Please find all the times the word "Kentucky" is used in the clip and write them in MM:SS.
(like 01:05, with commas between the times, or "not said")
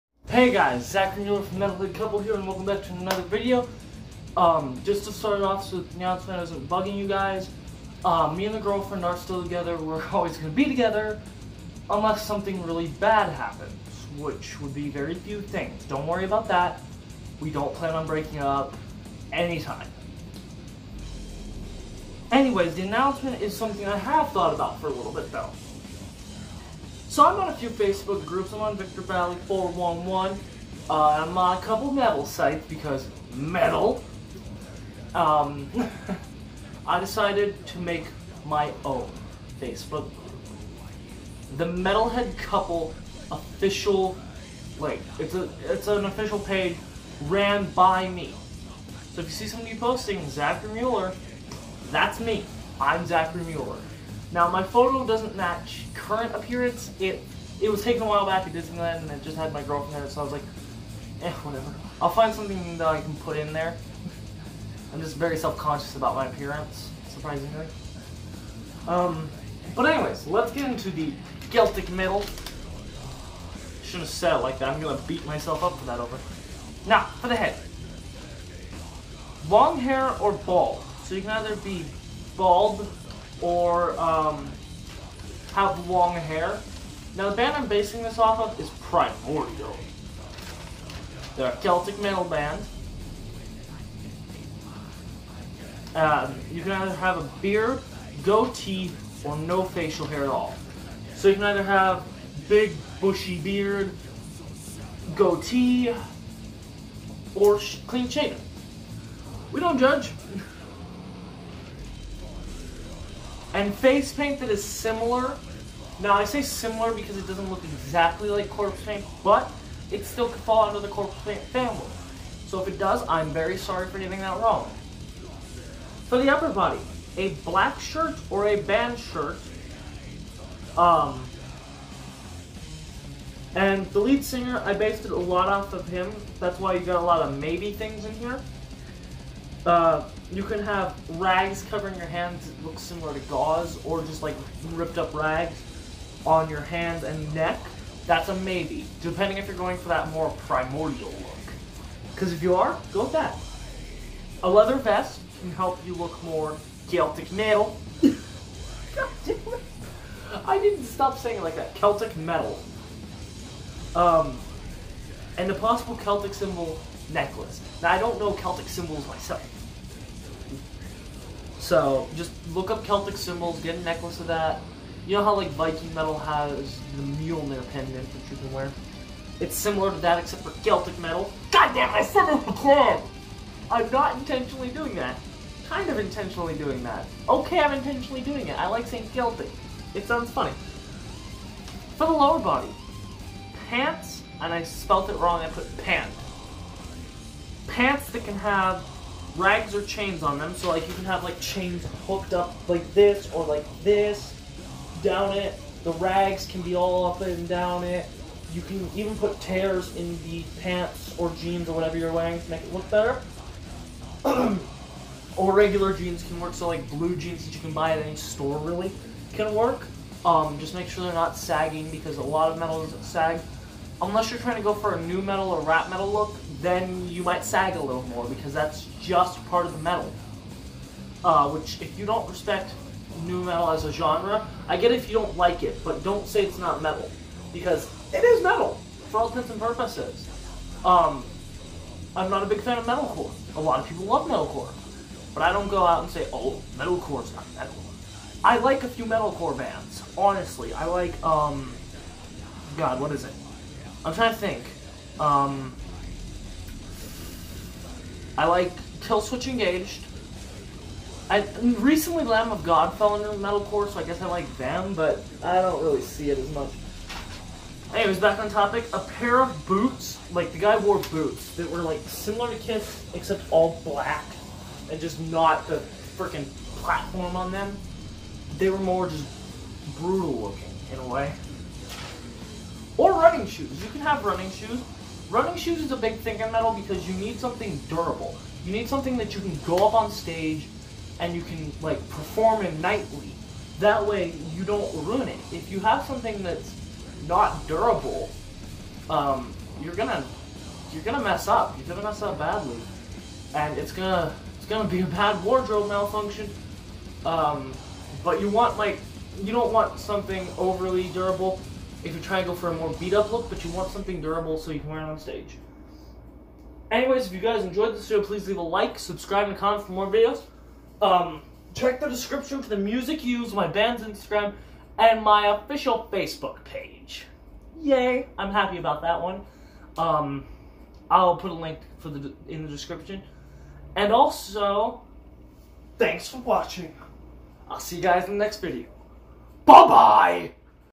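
not said.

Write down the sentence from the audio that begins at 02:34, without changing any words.
A leather vest can help you look more Celtic metal.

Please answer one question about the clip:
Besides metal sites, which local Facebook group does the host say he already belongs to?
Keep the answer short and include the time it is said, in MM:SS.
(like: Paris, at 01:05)
Victor Valley 411, at 00:28.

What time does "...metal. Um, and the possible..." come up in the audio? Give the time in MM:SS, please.
02:42.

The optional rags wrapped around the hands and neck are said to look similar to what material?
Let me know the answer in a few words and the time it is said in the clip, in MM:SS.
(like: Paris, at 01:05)
Gauze, at 02:23.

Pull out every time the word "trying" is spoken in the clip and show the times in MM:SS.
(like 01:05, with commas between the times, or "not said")
03:44, 04:14, 05:12.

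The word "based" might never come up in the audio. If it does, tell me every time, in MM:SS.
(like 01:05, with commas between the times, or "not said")
02:14.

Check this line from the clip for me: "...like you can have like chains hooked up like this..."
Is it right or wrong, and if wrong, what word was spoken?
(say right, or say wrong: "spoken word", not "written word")
right.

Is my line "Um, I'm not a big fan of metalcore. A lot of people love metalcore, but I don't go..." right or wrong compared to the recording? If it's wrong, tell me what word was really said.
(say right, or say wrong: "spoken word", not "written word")
right.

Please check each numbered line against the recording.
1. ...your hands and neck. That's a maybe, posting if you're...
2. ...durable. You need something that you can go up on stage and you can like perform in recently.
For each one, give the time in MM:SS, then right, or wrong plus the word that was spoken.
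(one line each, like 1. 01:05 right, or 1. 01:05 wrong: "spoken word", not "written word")
1. 02:26 wrong: "depending", not "posting"
2. 04:47 wrong: "nightly", not "recently".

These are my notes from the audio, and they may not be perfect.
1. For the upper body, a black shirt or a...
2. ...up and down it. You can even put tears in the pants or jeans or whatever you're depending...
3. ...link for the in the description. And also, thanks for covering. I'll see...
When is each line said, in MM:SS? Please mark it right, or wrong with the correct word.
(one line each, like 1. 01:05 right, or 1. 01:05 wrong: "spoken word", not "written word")
1. 02:06 right
2. 03:27 wrong: "wearing", not "depending"
3. 05:31 wrong: "watching", not "covering".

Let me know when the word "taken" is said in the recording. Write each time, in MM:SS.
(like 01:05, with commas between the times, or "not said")
00:57.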